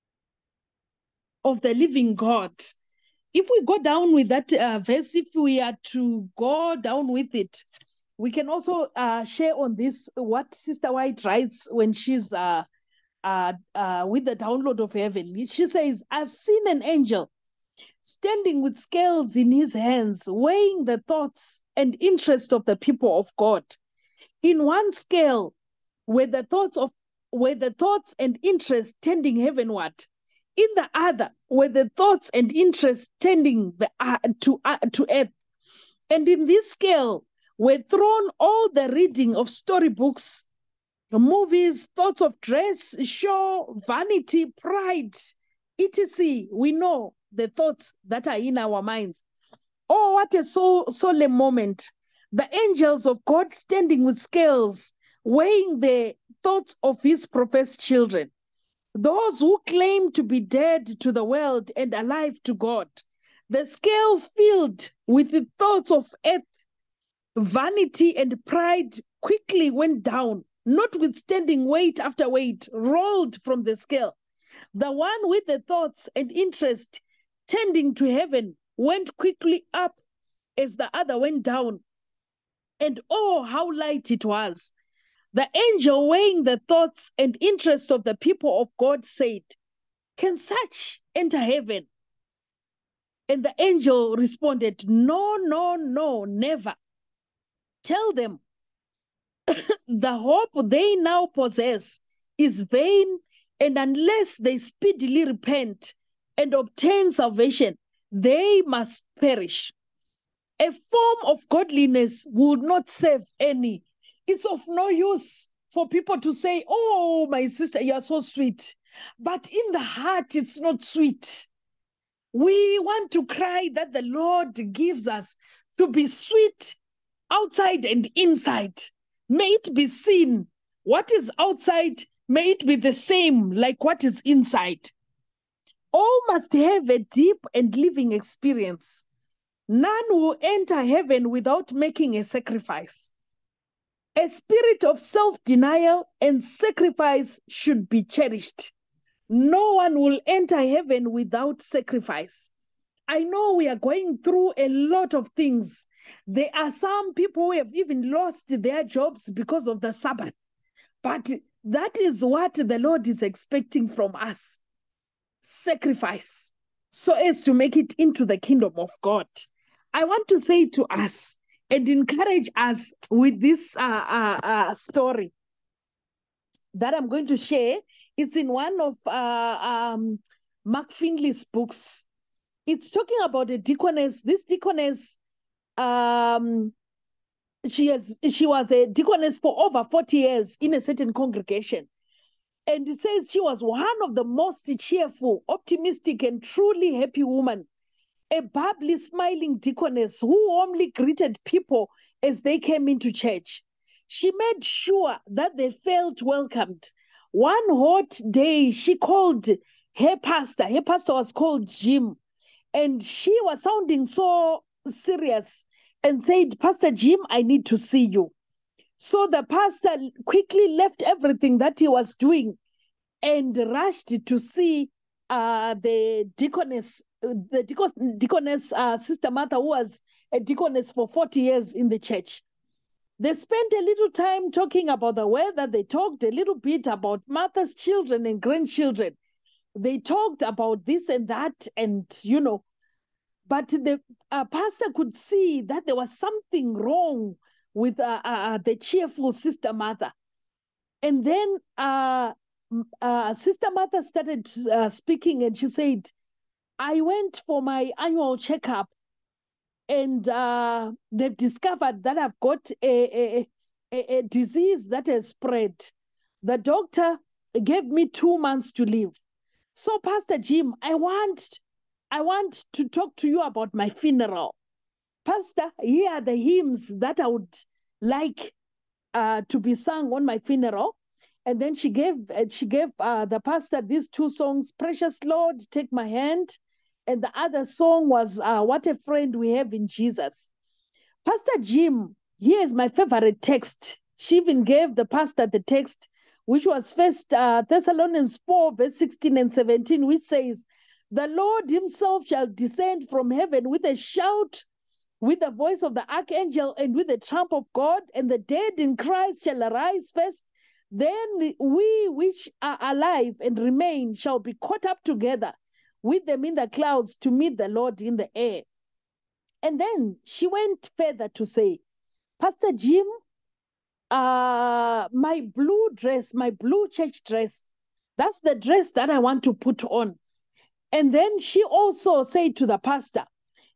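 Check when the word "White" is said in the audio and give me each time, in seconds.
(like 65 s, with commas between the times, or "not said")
10 s.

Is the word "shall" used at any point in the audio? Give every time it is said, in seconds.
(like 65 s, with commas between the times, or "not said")
302 s, 309 s, 314 s.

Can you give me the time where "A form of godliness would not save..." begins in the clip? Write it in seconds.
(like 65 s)
110 s.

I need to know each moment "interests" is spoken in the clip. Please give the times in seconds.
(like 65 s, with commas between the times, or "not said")
22 s, 28 s, 32 s, 76 s, 87 s.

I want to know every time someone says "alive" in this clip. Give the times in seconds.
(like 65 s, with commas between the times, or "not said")
61 s, 312 s.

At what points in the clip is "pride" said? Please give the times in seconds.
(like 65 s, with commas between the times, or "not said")
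44 s, 68 s.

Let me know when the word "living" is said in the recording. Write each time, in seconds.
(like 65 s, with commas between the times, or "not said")
1 s, 137 s.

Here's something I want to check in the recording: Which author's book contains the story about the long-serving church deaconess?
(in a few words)
Mark Finley.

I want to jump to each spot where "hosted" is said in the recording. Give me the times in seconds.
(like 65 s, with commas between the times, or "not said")
not said.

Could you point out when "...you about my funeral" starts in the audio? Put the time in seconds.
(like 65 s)
273 s.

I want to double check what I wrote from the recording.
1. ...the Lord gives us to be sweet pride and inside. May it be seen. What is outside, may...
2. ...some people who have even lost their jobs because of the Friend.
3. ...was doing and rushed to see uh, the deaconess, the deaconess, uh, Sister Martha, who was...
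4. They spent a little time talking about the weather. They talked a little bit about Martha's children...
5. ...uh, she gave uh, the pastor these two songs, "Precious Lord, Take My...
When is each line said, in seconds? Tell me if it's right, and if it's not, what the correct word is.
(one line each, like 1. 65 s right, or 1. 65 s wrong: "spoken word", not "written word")
1. 123 s wrong: "outside", not "pride"
2. 156 s wrong: "Sabbath", not "Friend"
3. 221 s right
4. 233 s right
5. 282 s right.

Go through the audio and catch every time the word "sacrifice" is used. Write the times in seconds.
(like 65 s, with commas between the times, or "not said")
142 s, 146 s, 151 s, 165 s.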